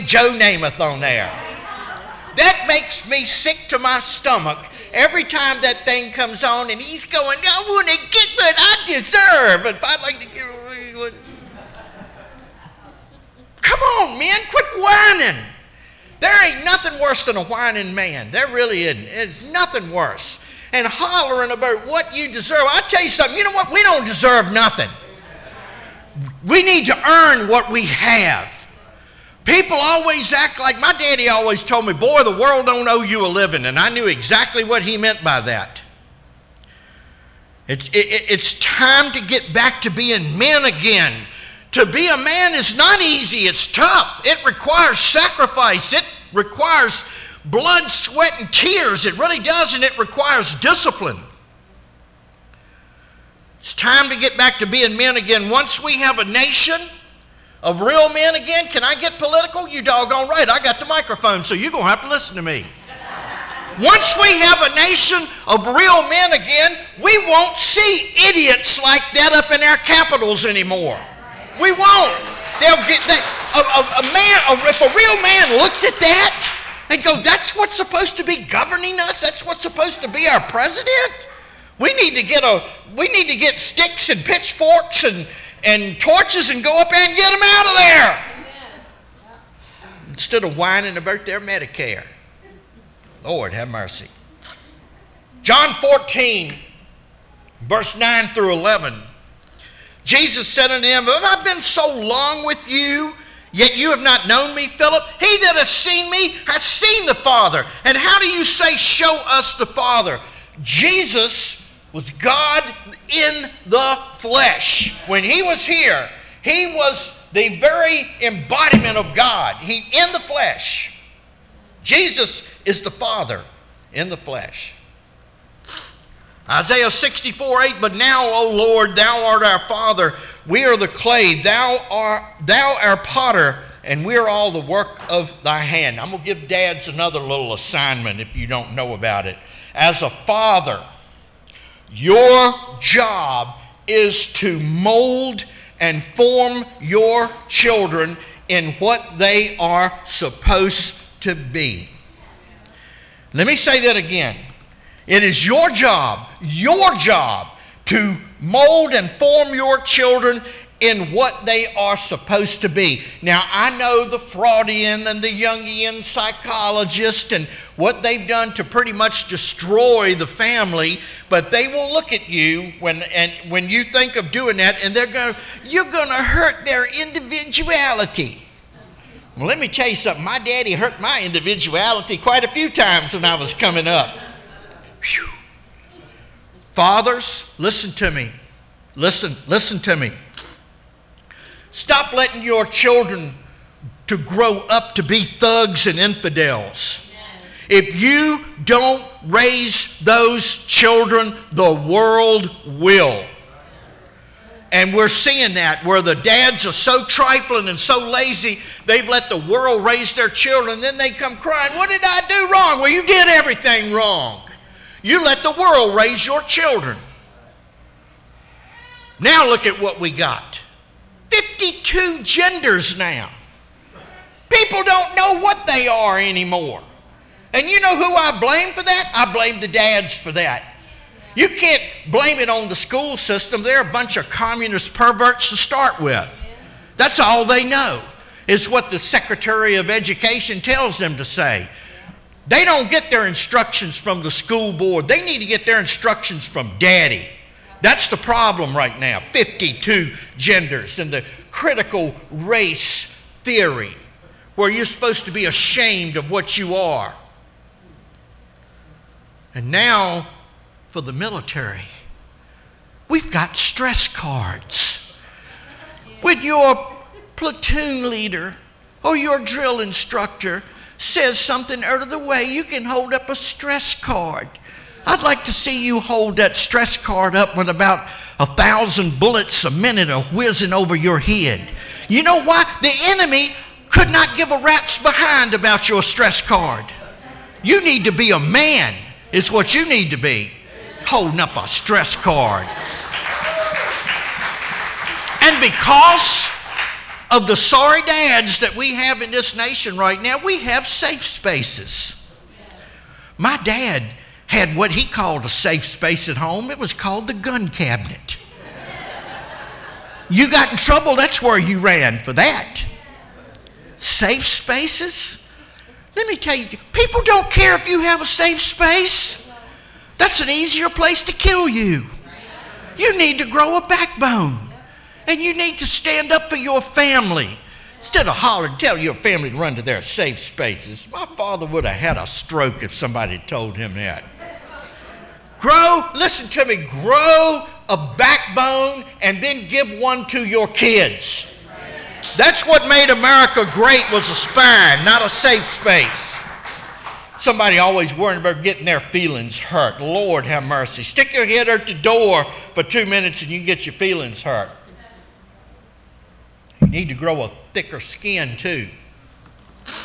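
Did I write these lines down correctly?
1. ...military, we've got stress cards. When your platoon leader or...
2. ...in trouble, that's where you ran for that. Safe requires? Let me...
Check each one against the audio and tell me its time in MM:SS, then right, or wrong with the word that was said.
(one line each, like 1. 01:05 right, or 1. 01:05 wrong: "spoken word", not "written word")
1. 04:21 right
2. 05:10 wrong: "spaces", not "requires".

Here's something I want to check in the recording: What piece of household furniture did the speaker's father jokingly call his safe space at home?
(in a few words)
The gun cabinet.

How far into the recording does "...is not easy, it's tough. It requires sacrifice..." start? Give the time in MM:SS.
00:42.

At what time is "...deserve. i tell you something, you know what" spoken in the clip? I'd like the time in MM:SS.
00:22.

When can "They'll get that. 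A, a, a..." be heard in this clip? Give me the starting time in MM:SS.
01:12.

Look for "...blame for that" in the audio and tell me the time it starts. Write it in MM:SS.
03:48.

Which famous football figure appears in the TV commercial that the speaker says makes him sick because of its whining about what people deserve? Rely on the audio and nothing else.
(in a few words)
Joe Namath.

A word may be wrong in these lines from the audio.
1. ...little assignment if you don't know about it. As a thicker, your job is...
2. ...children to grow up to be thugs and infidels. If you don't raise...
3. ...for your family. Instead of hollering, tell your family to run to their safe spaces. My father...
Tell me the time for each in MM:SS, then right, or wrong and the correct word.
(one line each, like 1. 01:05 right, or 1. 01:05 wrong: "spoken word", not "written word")
1. 02:17 wrong: "father", not "thicker"
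2. 03:12 right
3. 05:26 right.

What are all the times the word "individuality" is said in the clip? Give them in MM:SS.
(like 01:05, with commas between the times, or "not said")
02:56, 03:01.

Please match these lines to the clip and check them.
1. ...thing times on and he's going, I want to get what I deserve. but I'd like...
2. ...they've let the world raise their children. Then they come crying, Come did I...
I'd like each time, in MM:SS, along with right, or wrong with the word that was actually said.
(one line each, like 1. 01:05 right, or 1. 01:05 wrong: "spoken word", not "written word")
1. 00:05 wrong: "comes", not "times"
2. 03:28 wrong: "What", not "Come".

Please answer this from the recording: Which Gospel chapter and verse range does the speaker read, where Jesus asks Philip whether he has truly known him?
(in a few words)
John 14:9-11.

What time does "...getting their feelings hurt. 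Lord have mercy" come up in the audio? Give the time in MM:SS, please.
05:48.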